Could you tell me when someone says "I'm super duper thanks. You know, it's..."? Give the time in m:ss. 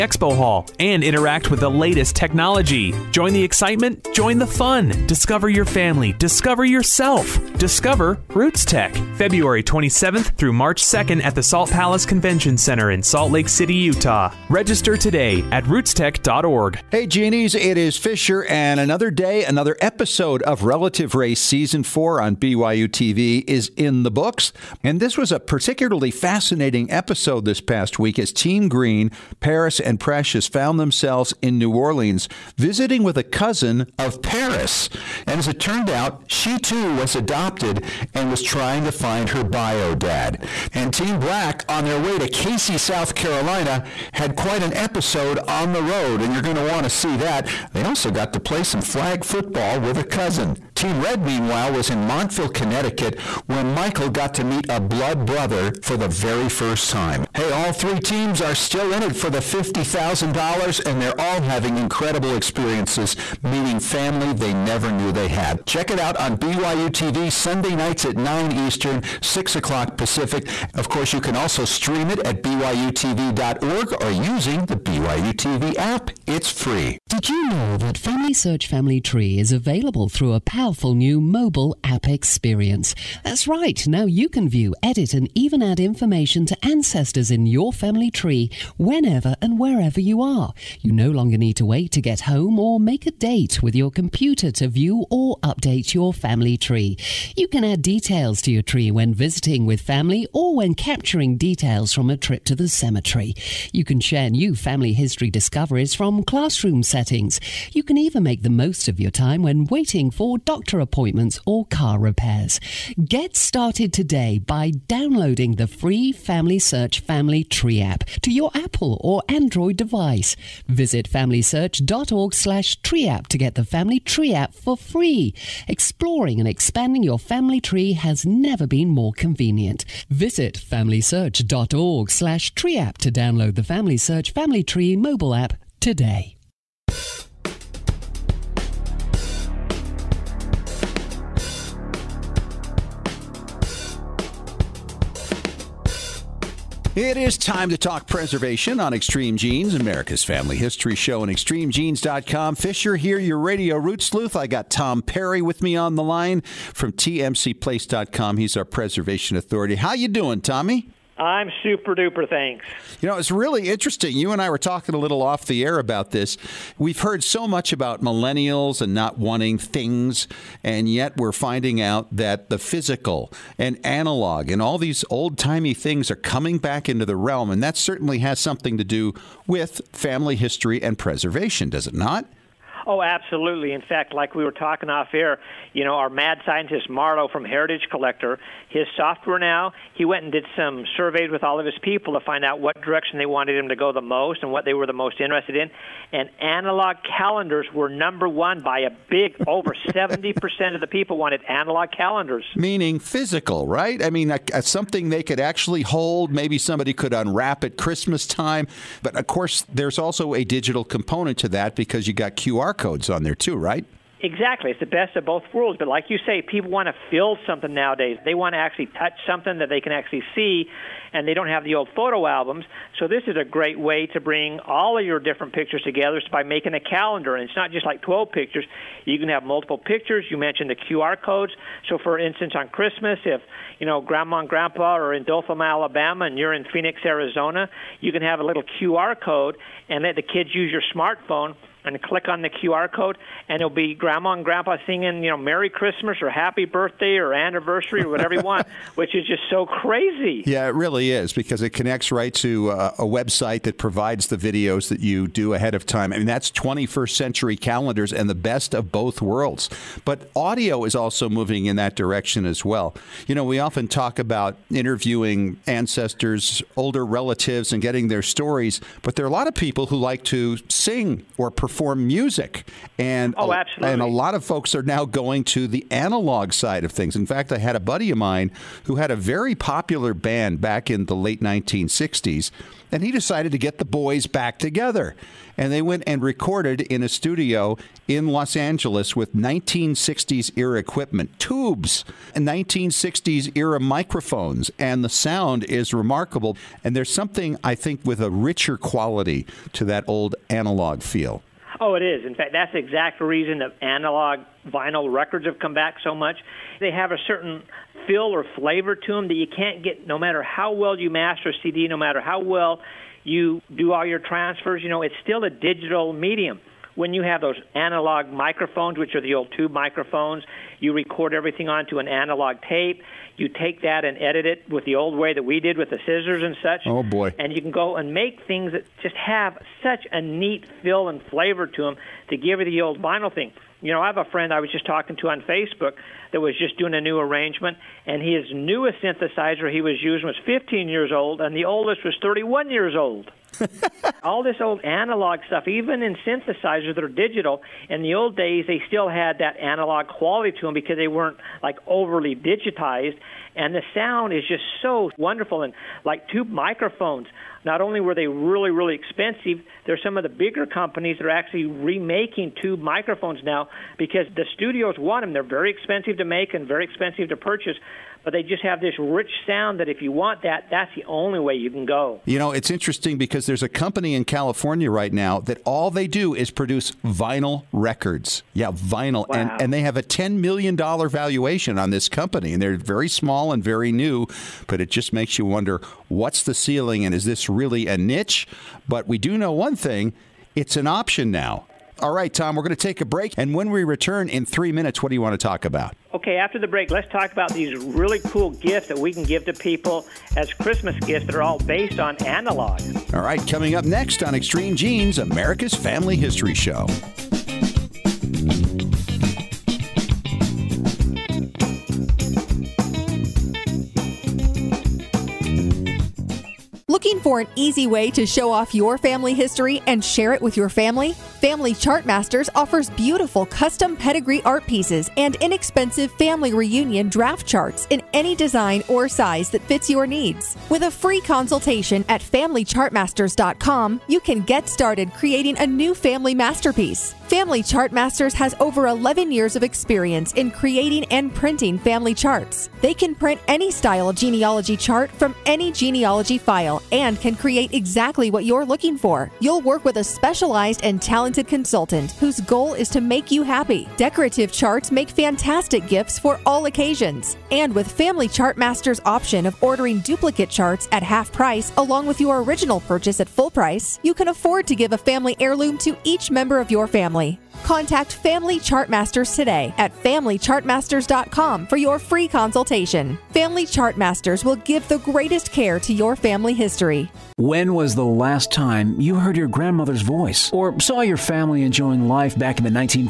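2:41.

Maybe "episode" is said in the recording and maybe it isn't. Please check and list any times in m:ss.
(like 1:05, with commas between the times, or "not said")
0:19, 0:26, 0:44.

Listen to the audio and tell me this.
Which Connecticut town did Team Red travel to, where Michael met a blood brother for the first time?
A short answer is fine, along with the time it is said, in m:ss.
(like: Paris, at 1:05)
Montville, at 0:52.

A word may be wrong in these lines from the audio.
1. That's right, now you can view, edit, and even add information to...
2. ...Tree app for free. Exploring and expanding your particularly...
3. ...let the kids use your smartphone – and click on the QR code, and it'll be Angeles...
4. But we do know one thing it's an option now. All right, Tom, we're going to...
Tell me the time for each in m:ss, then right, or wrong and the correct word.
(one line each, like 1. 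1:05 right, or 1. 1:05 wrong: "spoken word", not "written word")
1. 1:23 right
2. 2:03 wrong: "family", not "particularly"
3. 4:00 wrong: "Grandma", not "Angeles"
4. 6:28 right.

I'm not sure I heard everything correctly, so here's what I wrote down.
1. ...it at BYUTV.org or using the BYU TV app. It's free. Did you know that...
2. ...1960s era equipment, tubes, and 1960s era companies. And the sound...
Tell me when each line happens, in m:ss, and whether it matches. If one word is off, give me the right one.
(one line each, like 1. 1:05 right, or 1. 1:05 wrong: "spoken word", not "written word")
1. 1:12 right
2. 4:49 wrong: "microphones", not "companies".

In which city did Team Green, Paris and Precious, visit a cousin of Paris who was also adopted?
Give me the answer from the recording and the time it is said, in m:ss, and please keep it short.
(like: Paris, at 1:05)
New Orleans, at 0:31.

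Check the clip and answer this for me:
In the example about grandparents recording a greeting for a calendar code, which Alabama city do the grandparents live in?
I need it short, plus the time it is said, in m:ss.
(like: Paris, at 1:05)
Dothan, at 3:55.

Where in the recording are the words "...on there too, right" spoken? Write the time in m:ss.
3:33.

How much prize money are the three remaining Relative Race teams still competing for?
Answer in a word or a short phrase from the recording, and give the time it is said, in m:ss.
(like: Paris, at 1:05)
$50,000, at 0:59.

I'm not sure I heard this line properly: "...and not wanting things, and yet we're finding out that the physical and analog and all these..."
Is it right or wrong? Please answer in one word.
right.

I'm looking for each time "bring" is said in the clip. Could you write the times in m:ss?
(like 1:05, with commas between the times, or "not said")
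3:44.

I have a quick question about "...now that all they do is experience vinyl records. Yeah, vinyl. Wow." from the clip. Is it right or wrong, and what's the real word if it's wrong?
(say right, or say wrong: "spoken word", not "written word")
wrong: "produce", not "experience".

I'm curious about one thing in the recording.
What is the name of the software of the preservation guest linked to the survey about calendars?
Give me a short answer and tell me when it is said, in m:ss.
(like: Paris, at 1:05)
Heritage Collector, at 3:07.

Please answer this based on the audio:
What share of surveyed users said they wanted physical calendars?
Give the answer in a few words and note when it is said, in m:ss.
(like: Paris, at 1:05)
over 70%, at 3:19.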